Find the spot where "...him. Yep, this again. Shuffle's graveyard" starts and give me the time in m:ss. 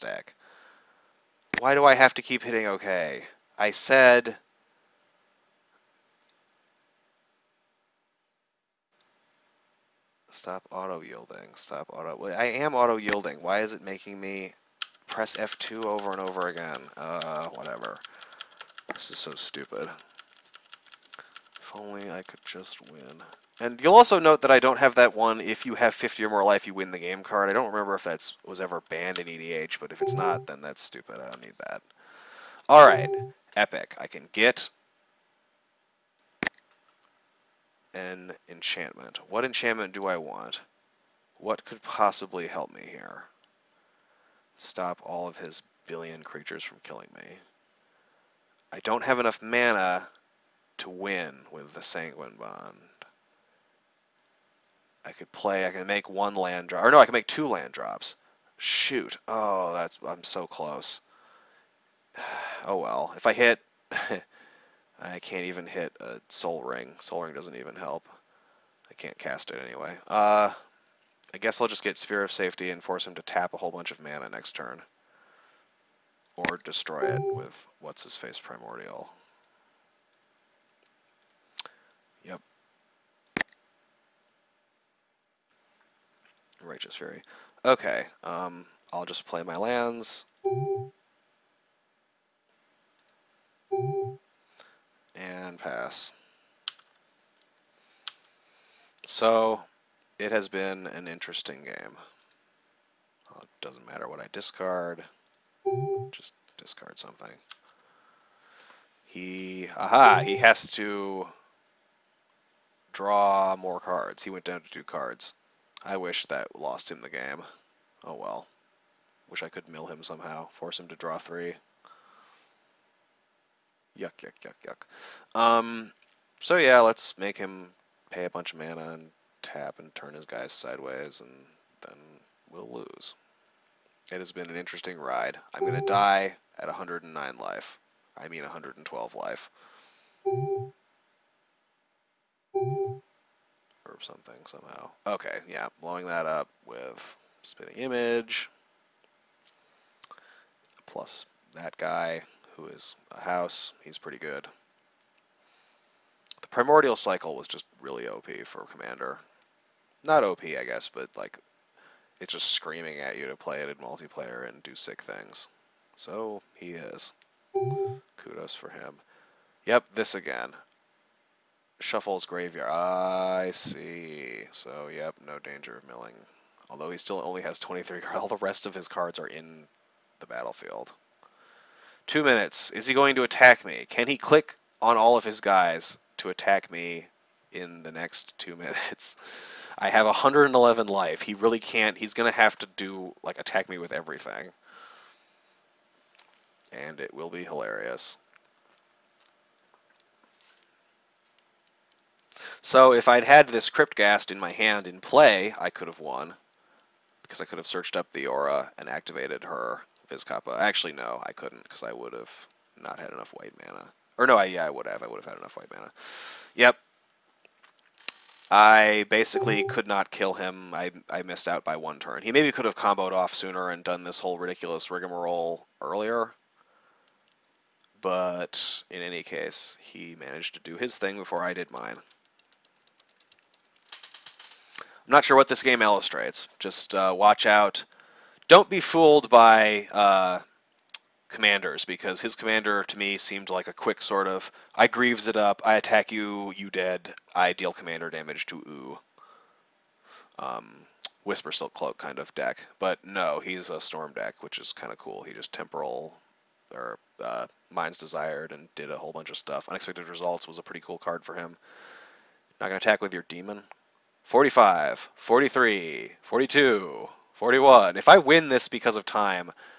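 2:48.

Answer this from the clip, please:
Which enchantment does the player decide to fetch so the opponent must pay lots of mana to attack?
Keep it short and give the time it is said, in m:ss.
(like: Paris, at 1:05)
Sphere of Safety, at 1:11.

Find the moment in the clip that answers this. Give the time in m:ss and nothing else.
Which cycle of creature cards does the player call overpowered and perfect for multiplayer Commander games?
2:36.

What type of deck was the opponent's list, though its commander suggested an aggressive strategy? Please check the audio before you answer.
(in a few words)
A Storm deck.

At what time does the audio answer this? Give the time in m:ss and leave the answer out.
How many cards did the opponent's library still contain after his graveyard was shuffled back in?
2:57.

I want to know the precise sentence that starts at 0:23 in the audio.
And you'll also note that I don't have that one, if you have 50 or more life, you win the game card.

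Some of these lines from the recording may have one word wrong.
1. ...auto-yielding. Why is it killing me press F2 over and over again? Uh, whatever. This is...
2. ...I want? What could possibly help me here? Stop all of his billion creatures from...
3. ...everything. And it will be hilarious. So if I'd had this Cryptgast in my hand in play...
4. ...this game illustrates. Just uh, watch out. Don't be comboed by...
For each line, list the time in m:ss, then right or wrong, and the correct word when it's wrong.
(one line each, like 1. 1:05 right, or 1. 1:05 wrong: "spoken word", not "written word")
1. 0:12 wrong: "making", not "killing"
2. 0:40 right
3. 3:13 right
4. 3:55 wrong: "fooled", not "comboed".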